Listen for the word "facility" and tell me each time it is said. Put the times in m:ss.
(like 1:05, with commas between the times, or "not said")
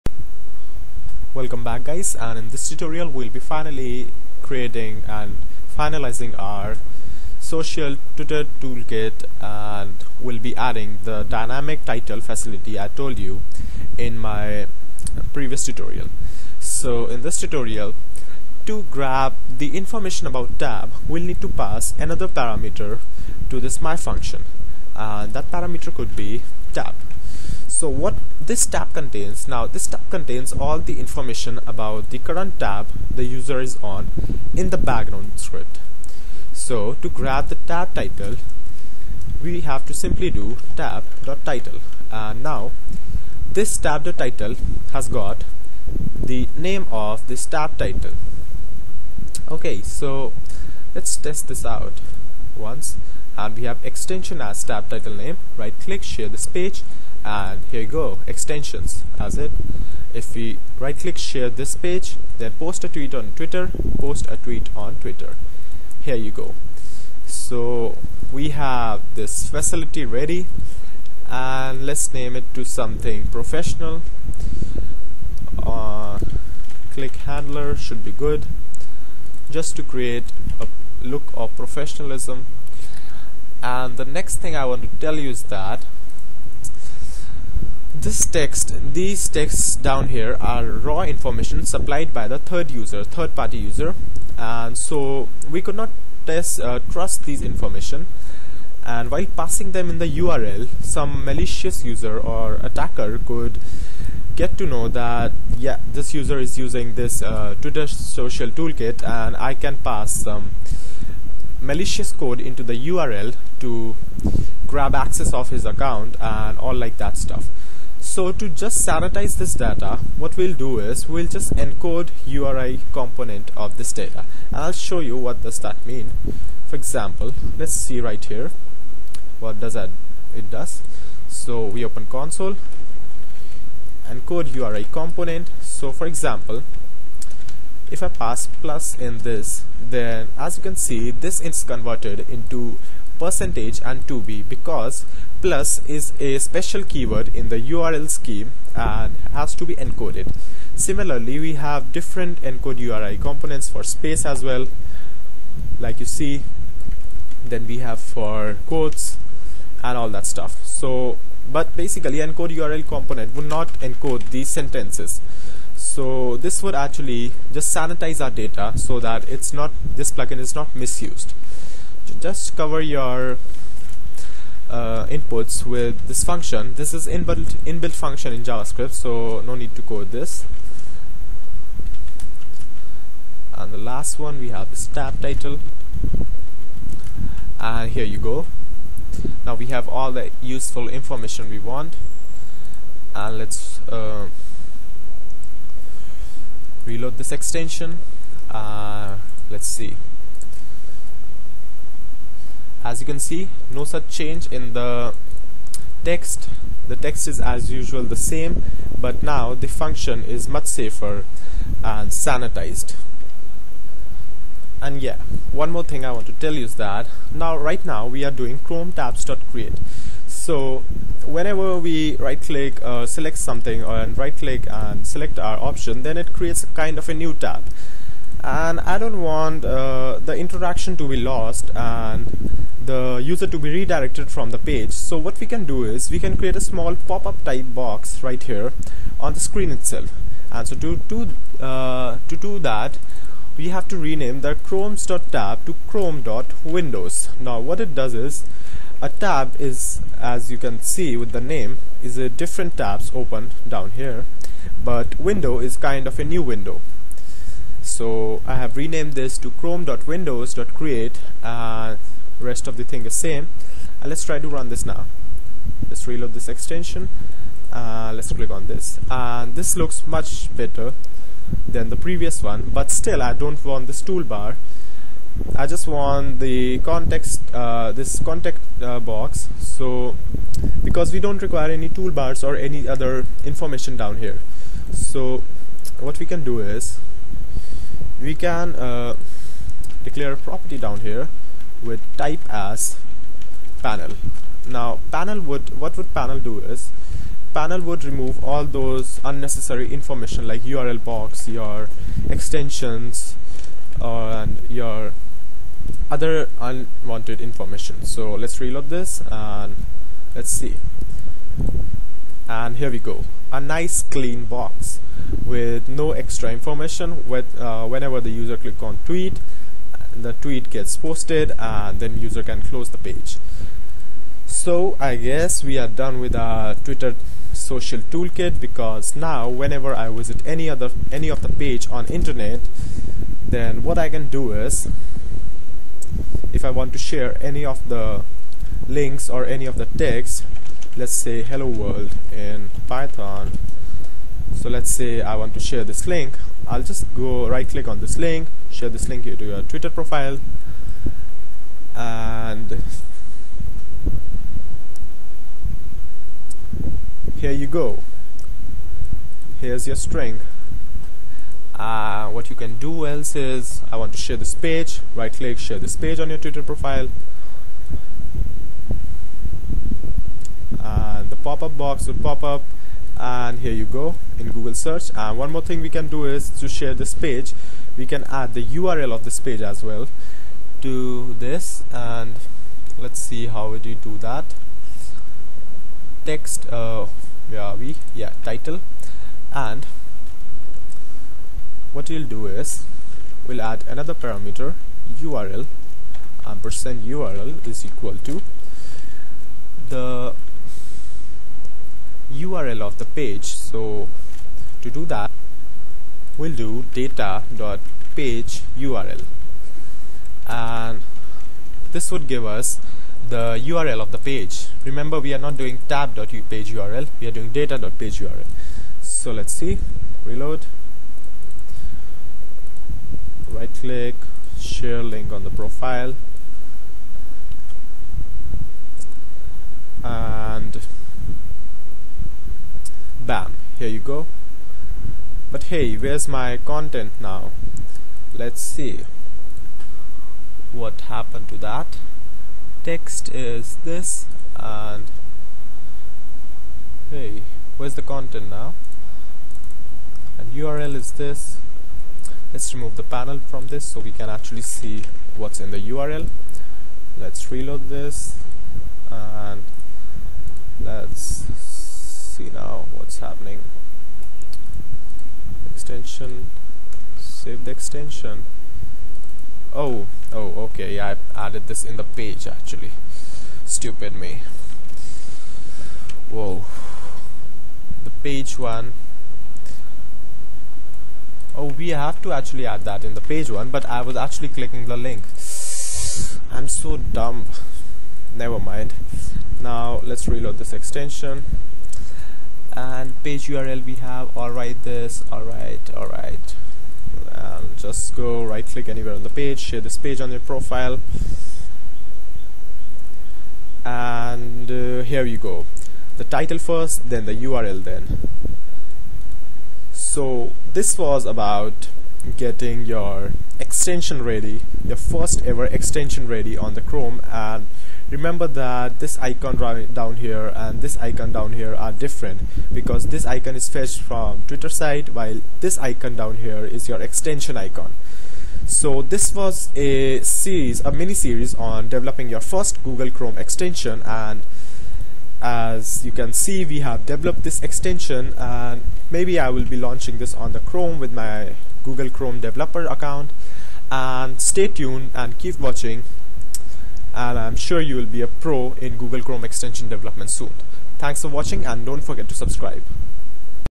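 0:12, 1:09.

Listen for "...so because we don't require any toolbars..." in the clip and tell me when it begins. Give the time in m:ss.
4:39.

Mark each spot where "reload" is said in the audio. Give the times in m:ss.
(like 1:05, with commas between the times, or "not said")
3:16, 4:26, 5:08, 7:00, 7:37, 8:10.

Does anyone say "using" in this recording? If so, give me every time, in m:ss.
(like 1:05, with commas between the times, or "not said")
1:46.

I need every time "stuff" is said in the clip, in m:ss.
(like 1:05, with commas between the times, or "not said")
1:57, 2:40.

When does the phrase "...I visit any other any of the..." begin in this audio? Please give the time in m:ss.
5:29.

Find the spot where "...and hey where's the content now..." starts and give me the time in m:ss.
7:24.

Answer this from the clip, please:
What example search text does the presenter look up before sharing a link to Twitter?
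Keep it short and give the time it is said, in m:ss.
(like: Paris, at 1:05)
hello world in Python, at 5:41.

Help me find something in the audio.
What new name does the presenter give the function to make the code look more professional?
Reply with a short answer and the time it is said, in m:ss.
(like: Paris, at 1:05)
click handler, at 1:16.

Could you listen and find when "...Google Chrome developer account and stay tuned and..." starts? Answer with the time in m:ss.
9:01.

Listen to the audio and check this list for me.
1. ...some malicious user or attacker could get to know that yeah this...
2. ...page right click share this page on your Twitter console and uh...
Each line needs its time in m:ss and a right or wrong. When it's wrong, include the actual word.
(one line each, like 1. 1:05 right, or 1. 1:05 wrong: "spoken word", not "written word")
1. 1:40 right
2. 6:04 wrong: "profile", not "console".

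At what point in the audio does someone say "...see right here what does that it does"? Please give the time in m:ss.
2:07.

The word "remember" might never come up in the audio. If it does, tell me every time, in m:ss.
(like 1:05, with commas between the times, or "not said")
6:54, 8:38.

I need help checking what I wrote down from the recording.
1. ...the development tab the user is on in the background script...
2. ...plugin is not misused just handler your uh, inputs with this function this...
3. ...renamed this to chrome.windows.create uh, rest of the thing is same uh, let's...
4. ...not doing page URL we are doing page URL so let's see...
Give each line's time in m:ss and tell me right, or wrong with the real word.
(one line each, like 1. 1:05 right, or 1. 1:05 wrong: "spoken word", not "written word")
1. 0:32 wrong: "current", not "development"
2. 2:50 wrong: "cover", not "handler"
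3. 4:18 right
4. 6:55 right.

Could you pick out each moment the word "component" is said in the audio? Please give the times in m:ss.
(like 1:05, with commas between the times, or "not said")
2:02, 2:14, 2:33, 2:42.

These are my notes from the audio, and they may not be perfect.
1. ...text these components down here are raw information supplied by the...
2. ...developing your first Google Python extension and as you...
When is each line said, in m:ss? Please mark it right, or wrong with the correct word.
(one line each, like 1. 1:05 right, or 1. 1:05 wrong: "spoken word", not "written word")
1. 1:28 wrong: "texts", not "components"
2. 8:51 wrong: "Chrome", not "Python".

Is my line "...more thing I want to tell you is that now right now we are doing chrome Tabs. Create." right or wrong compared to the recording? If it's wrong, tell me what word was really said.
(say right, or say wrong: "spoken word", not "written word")
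right.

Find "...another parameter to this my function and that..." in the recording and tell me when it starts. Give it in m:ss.
0:21.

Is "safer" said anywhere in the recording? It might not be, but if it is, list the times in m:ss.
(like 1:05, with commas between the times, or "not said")
3:30.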